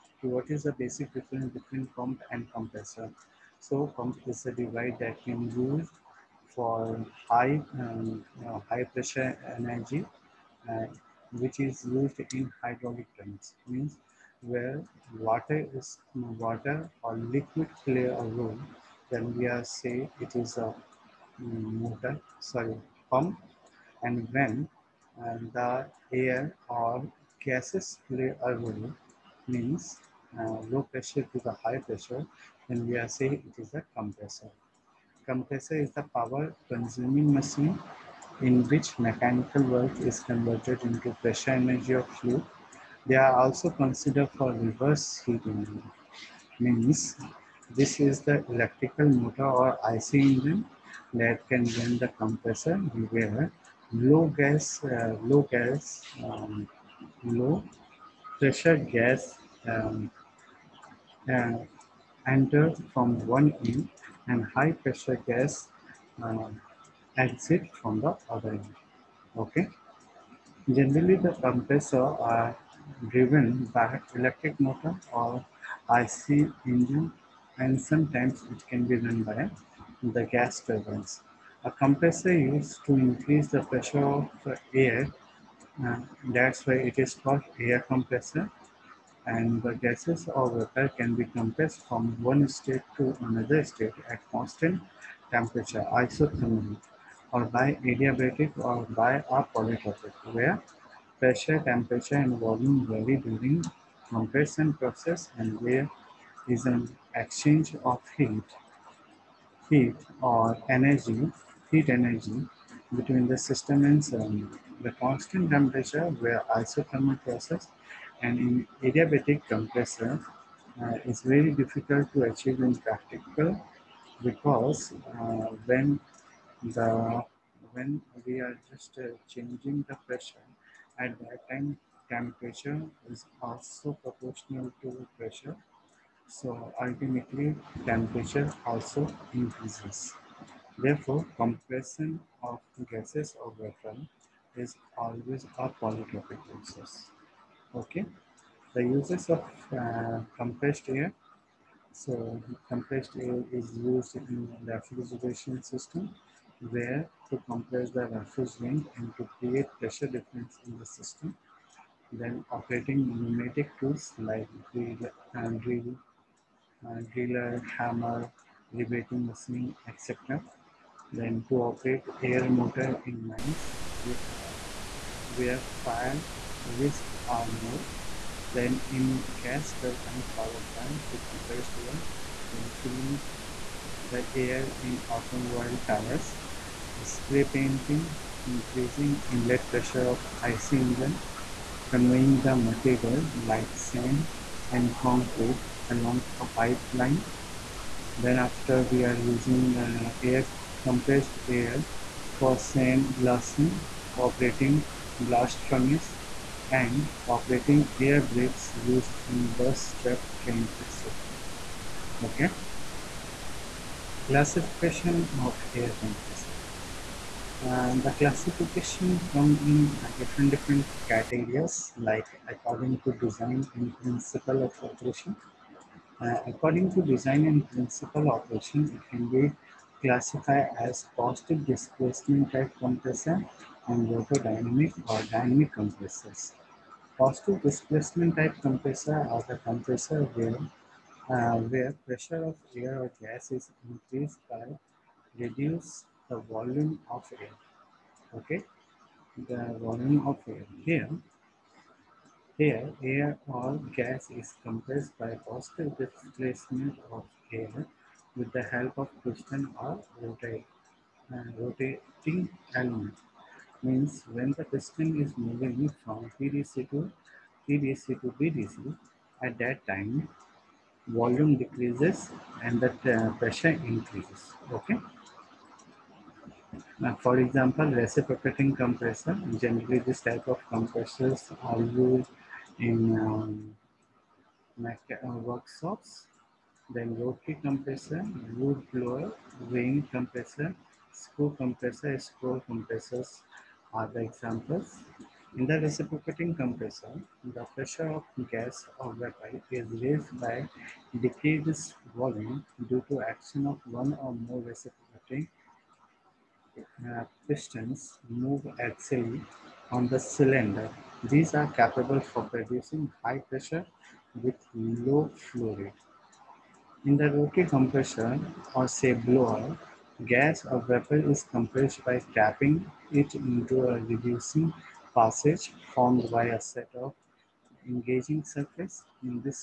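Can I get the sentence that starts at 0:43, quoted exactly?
They are also considered for reverse heat engine.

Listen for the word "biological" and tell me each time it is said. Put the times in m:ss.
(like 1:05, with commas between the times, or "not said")
not said.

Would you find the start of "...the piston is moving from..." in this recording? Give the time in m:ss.
4:24.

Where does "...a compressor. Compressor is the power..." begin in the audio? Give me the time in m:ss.
0:33.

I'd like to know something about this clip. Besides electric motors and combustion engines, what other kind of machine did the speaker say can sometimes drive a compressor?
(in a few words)
Gas turbines.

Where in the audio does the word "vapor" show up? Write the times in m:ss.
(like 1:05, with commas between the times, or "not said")
1:30, 2:23, 4:59, 5:20.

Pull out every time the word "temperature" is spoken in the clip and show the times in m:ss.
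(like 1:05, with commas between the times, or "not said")
1:35, 1:41, 1:55, 2:12, 2:17.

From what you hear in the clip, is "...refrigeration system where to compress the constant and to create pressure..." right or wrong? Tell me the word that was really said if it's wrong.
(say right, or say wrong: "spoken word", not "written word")
wrong: "refrigerant", not "constant".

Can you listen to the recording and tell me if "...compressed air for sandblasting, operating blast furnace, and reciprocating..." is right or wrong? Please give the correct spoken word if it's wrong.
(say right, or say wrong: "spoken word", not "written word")
wrong: "operating", not "reciprocating".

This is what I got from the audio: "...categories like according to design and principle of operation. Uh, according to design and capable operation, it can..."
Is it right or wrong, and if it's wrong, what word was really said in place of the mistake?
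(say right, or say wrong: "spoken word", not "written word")
wrong: "principle", not "capable".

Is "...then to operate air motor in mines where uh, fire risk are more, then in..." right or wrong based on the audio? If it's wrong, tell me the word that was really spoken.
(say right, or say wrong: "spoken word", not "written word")
right.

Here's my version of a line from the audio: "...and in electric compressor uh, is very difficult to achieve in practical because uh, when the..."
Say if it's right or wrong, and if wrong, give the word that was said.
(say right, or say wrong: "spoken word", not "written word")
wrong: "adiabatic", not "electric".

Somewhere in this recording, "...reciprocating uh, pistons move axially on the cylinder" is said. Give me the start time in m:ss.
5:04.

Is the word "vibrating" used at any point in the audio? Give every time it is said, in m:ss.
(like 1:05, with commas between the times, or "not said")
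not said.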